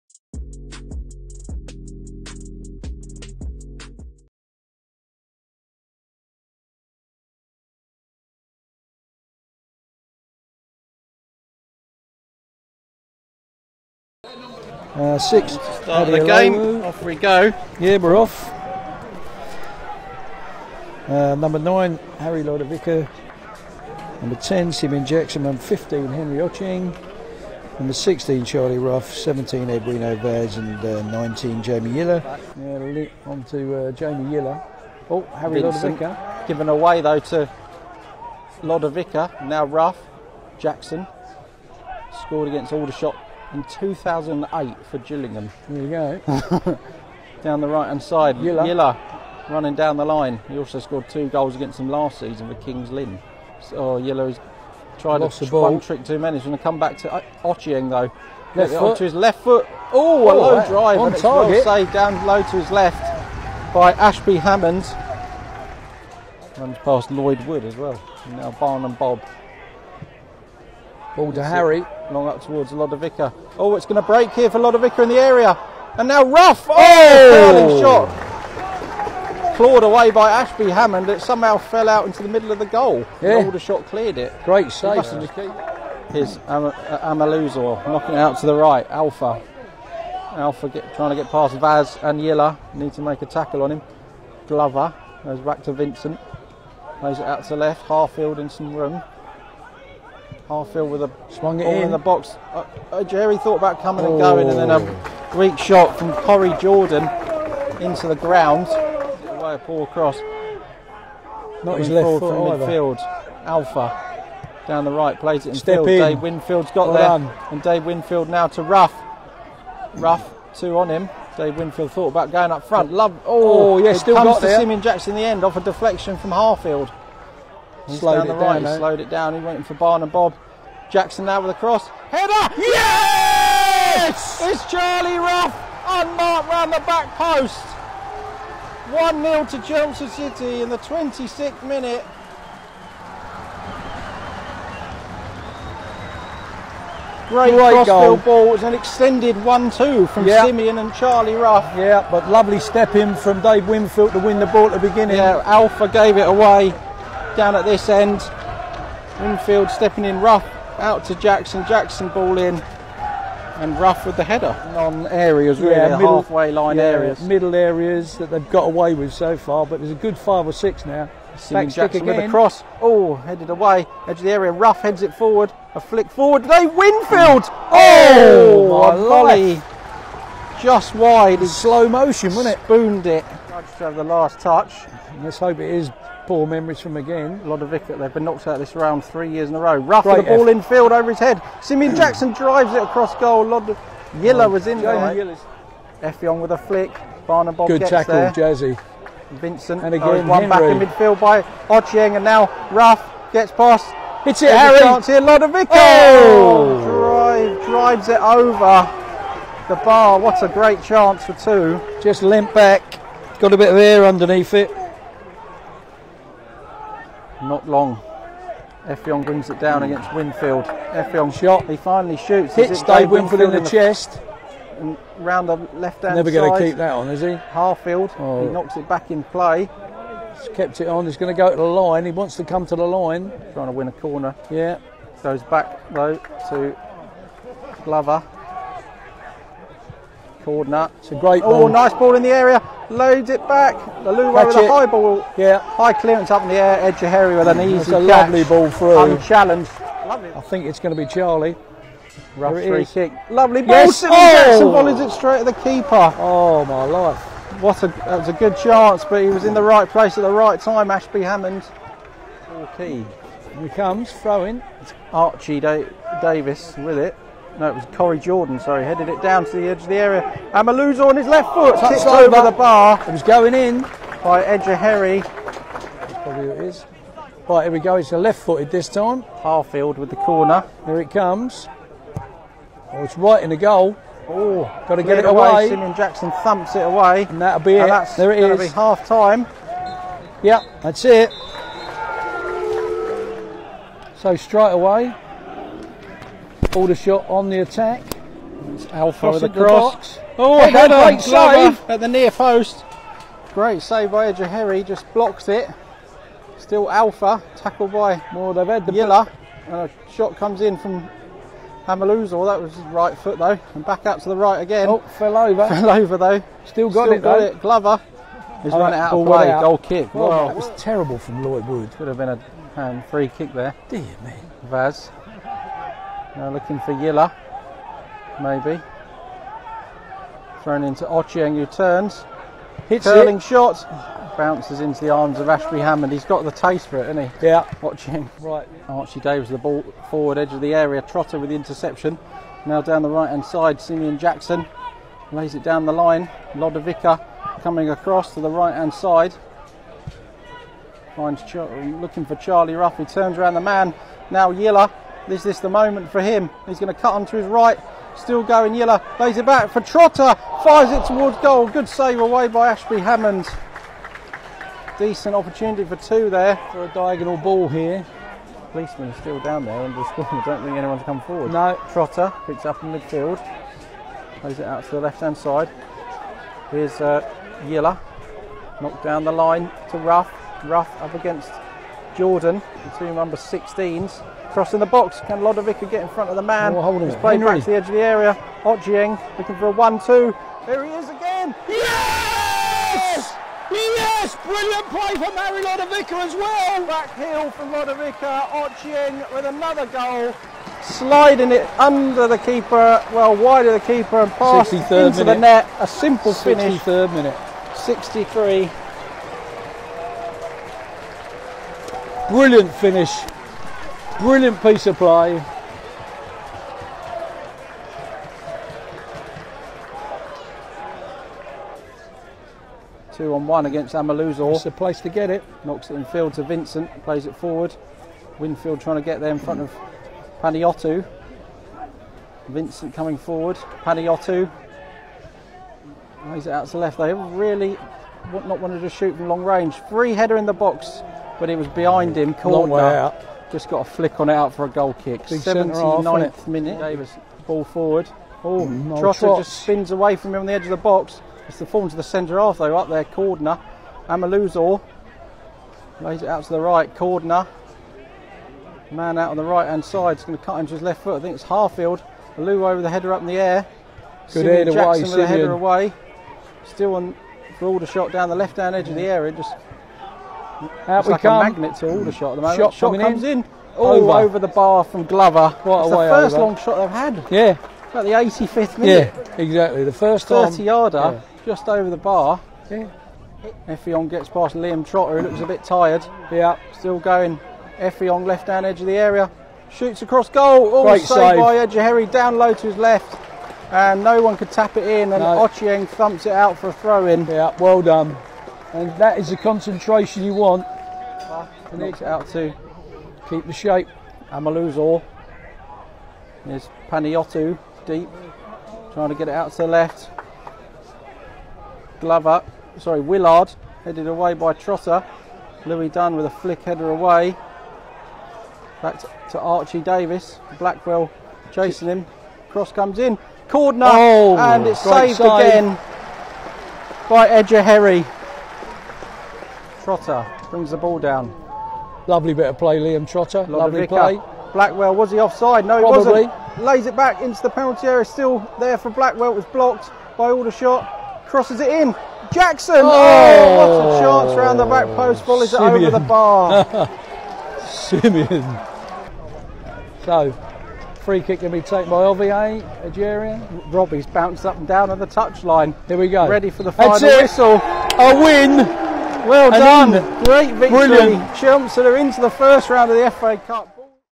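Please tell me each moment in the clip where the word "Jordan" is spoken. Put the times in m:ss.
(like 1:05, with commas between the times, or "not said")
1:46, 4:28, 6:22.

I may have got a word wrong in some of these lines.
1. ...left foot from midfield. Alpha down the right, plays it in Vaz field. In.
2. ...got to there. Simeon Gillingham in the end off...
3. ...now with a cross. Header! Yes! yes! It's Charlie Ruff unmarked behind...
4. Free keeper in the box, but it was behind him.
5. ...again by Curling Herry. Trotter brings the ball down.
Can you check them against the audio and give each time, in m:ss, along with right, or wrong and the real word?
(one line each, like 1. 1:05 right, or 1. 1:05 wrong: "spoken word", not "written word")
1. 1:51 wrong: "Step", not "Vaz"
2. 2:04 wrong: "Jackson", not "Gillingham"
3. 2:11 wrong: "round", not "behind"
4. 7:19 wrong: "header", not "keeper"
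5. 8:45 wrong: "Edger", not "Curling".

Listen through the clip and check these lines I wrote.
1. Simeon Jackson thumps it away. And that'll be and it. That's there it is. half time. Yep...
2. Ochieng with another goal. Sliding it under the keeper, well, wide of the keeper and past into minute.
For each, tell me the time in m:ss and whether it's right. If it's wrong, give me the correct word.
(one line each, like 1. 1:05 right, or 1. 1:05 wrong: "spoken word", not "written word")
1. 4:45 right
2. 6:38 right.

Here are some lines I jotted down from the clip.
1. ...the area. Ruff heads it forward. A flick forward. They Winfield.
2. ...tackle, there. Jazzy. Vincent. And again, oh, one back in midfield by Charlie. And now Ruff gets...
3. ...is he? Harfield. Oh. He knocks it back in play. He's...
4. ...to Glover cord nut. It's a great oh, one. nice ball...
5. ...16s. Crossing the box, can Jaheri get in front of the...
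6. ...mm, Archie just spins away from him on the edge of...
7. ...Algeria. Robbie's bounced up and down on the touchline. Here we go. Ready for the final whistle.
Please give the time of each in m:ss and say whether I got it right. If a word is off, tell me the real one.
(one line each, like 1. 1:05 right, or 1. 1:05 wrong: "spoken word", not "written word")
1. 2:54 right
2. 3:17 wrong: "Ochieng", not "Charlie"
3. 3:47 right
4. 3:56 right
5. 6:23 wrong: "Lodovica", not "Jaheri"
6. 7:28 wrong: "Trotter", not "Archie"
7. 9:12 right.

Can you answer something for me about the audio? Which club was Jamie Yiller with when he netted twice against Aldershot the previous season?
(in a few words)
Kings Lynn.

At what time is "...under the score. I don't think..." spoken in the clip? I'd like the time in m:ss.
6:09.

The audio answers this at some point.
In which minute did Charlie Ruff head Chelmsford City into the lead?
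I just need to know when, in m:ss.
2:20.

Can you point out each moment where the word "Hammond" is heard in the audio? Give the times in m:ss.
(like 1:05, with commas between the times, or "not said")
1:04, 1:20, 4:21, 5:35, 6:02.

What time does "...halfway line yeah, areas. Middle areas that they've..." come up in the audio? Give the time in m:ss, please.
2:46.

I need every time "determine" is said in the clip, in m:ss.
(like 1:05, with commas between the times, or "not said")
not said.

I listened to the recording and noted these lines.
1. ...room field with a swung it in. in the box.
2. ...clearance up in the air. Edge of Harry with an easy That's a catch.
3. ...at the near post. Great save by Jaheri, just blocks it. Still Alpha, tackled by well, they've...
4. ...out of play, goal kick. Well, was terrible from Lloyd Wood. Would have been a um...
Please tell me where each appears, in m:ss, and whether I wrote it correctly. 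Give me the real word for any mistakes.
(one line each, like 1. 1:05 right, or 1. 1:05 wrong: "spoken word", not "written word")
1. 1:38 right
2. 4:05 right
3. 5:01 right
4. 5:18 right.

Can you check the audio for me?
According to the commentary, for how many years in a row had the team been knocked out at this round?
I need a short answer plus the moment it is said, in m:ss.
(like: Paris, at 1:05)
3, at 3:09.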